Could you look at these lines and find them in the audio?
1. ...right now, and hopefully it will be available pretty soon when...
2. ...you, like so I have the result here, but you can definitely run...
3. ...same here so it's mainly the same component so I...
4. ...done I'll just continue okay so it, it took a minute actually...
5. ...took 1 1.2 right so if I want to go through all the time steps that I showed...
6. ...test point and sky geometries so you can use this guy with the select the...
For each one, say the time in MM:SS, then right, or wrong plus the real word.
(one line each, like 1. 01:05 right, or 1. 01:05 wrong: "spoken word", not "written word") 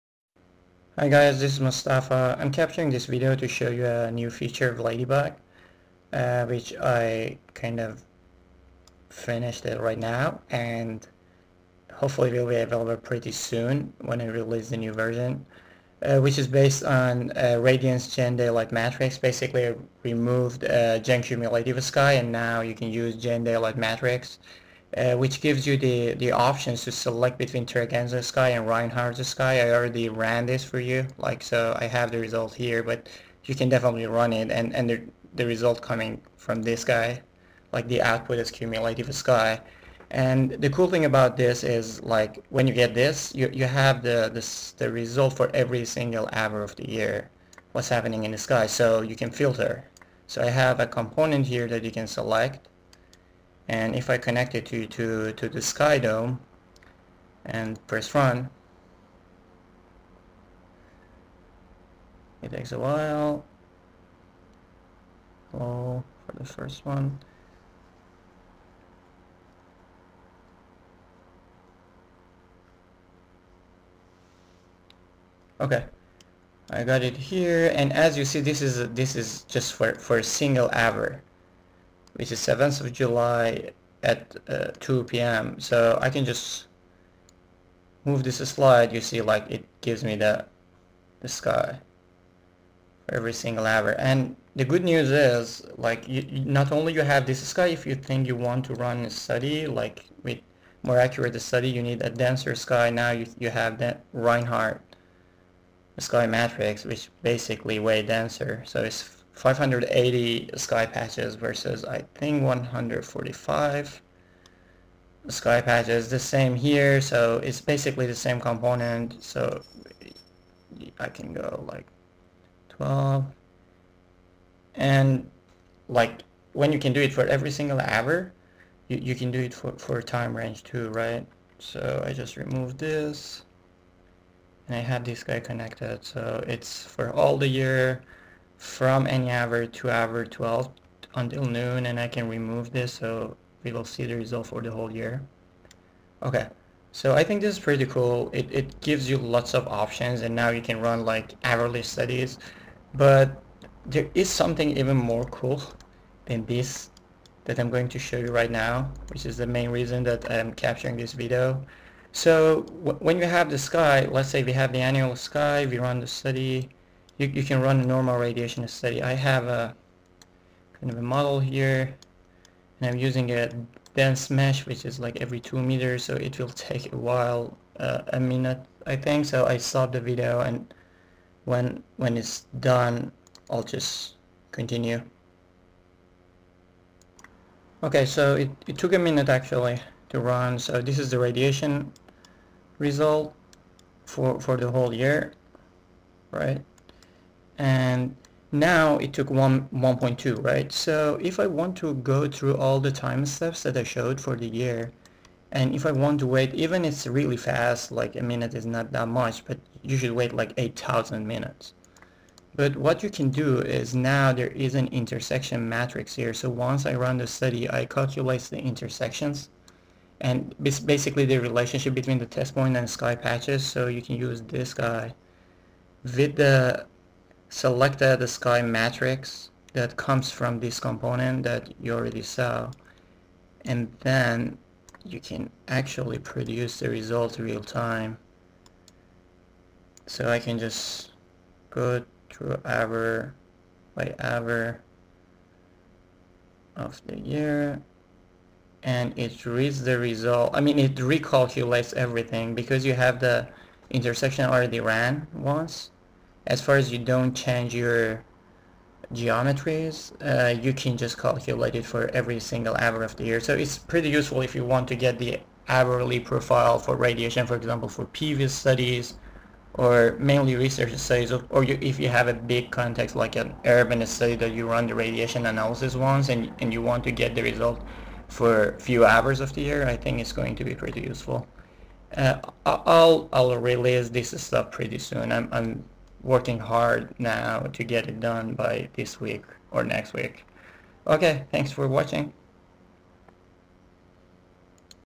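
1. 00:09 right
2. 00:30 right
3. 01:56 wrong: "basically", not "mainly"
4. 03:02 right
5. 03:19 right
6. 03:42 wrong: "patches", not "geometries".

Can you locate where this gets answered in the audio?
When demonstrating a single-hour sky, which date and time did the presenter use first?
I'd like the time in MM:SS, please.
01:22.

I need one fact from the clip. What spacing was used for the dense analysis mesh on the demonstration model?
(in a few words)
2 meters.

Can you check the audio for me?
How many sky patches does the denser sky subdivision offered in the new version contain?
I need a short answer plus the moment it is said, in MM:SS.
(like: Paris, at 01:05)
580, at 01:49.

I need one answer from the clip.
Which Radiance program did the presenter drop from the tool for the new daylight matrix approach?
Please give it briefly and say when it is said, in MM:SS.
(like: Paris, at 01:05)
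Gen Cumulative Sky, at 00:20.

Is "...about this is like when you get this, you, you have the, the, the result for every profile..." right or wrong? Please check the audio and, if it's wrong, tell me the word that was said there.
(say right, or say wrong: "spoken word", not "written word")
wrong: "single", not "profile".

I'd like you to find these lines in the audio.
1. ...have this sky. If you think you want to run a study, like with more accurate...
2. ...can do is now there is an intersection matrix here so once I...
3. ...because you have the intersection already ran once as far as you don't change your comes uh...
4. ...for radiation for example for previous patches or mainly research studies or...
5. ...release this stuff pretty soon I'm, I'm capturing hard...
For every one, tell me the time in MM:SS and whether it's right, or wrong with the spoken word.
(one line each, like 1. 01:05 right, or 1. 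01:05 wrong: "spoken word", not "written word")
1. 01:37 right
2. 03:33 right
3. 04:12 wrong: "geometries", not "comes"
4. 04:26 wrong: "studies", not "patches"
5. 04:43 wrong: "working", not "capturing".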